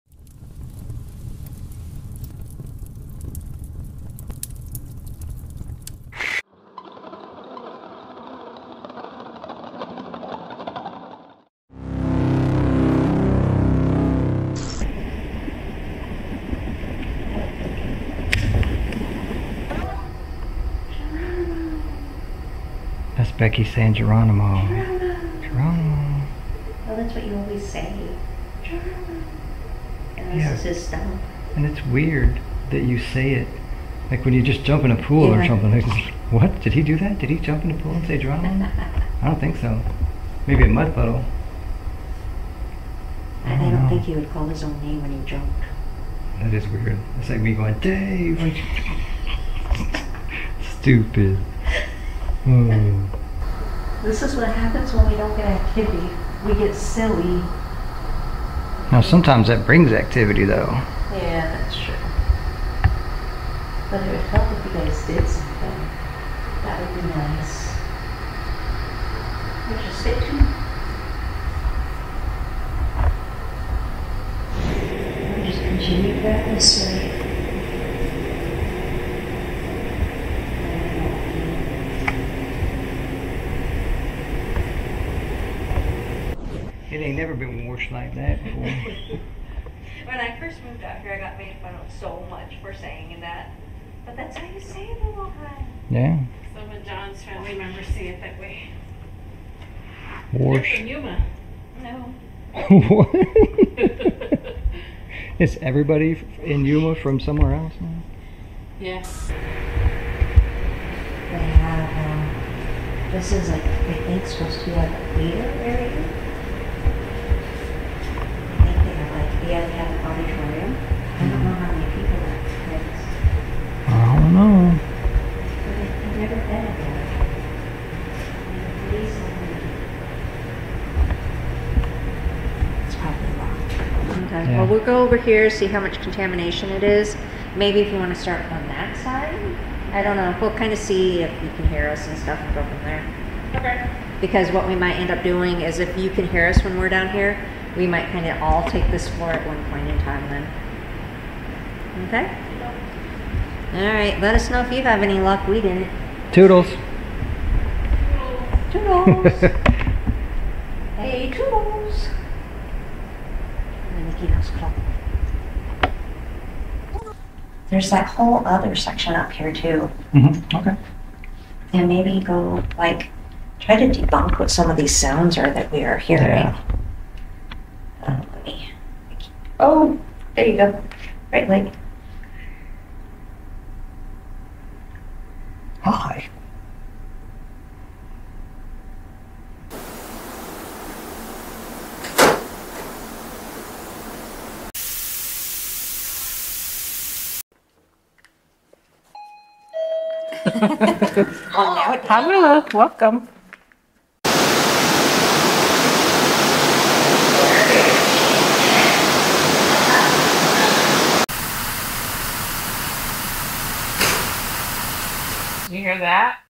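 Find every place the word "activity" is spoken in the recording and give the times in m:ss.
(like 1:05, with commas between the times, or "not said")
0:55, 0:59.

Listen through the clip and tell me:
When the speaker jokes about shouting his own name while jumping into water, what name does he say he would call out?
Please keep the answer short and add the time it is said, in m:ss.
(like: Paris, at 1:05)
Dave, at 0:47.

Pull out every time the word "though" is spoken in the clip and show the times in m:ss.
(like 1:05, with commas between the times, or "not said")
1:00.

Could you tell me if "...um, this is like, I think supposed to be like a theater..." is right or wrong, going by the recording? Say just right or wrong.
right.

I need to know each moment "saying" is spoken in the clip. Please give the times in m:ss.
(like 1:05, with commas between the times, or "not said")
0:23, 1:32.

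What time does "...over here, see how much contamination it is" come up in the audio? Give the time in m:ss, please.
2:15.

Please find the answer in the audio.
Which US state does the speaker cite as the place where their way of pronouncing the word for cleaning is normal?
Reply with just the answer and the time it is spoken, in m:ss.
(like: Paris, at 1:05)
Ohio, at 1:35.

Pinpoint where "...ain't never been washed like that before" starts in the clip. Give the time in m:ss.
1:26.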